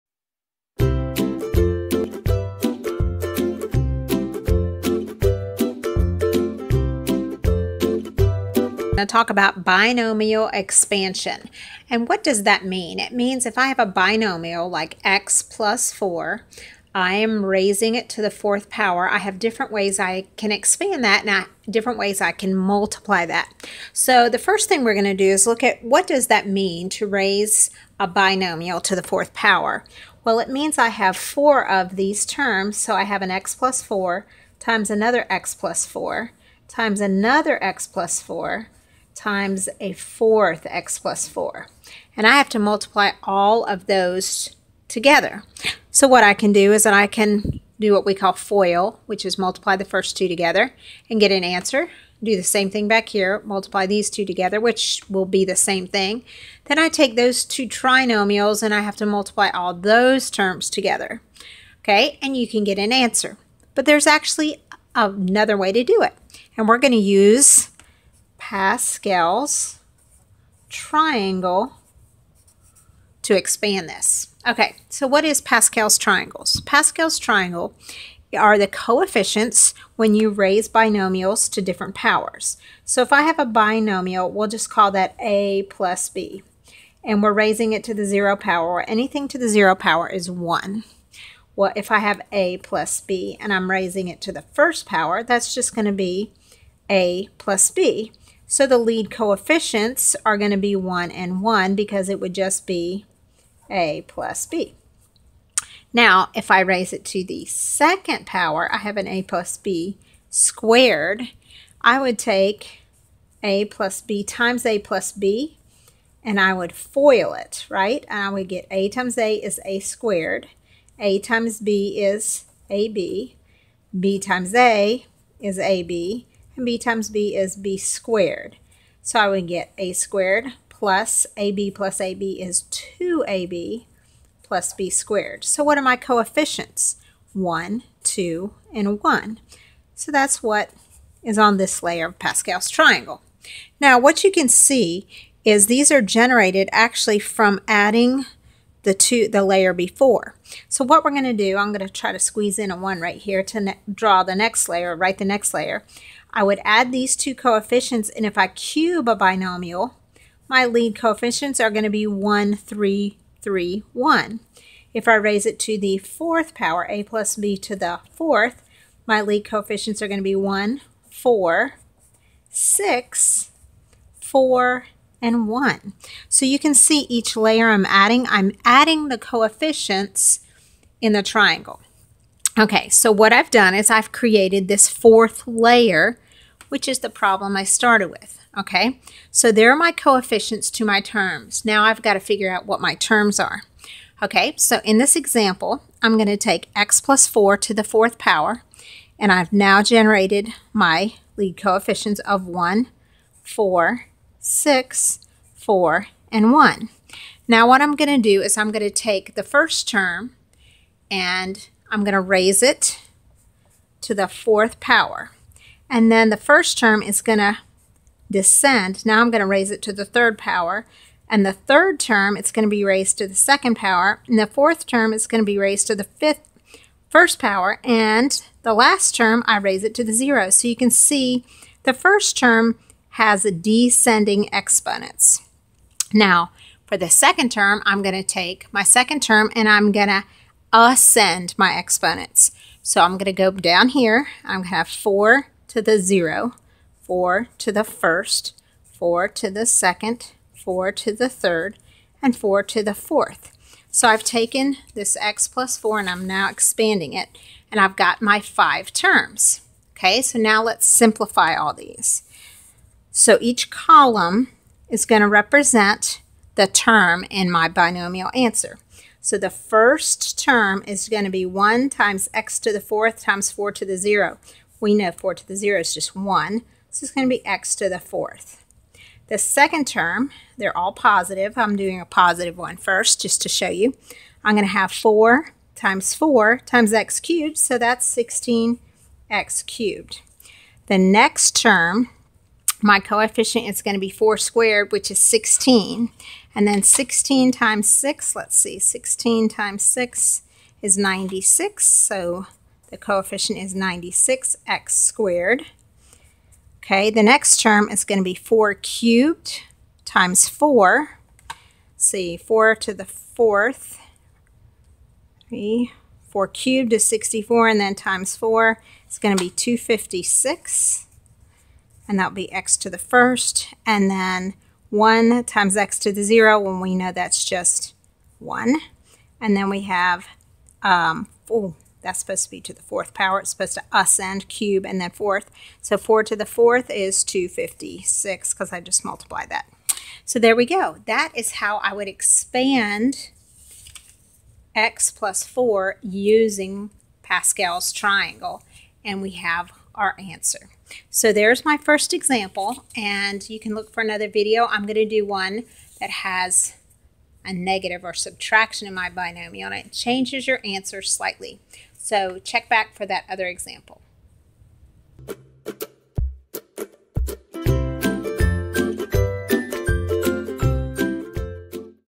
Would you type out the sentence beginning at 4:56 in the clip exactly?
And then 16 times 6, let's see, 16 times 6 is 96.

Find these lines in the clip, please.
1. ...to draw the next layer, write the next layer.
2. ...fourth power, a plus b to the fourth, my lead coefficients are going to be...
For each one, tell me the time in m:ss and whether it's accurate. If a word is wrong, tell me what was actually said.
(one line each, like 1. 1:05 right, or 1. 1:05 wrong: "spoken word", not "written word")
1. 2:33 right
2. 2:45 right.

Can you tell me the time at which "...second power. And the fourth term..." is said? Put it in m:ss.
3:43.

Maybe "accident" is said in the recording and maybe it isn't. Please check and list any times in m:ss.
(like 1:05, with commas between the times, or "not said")
not said.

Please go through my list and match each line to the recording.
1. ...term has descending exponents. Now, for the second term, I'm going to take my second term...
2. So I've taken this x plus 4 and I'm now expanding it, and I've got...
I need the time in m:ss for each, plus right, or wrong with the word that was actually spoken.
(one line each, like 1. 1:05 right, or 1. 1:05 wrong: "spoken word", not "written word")
1. 3:52 right
2. 4:13 right.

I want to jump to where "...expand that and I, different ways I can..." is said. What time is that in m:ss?
0:20.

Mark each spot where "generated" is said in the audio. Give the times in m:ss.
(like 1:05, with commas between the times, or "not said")
2:26, 3:19.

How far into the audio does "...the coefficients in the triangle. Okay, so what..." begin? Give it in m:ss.
2:59.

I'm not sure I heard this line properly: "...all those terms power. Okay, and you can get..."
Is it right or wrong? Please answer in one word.
wrong.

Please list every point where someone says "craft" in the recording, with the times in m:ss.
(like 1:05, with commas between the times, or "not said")
not said.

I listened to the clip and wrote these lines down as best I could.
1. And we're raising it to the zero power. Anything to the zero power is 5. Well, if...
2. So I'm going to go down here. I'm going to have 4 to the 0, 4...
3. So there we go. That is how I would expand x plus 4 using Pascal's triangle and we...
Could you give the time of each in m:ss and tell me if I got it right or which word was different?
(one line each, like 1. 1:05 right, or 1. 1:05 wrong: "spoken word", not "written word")
1. 1:27 wrong: "1", not "5"
2. 4:02 right
3. 5:40 right.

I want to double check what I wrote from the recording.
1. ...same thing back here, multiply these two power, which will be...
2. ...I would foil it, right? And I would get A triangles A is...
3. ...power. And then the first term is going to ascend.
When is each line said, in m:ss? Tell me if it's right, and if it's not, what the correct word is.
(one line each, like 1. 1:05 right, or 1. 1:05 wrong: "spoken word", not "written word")
1. 0:52 wrong: "together", not "power"
2. 1:56 wrong: "times", not "triangles"
3. 3:34 wrong: "descend", not "ascend".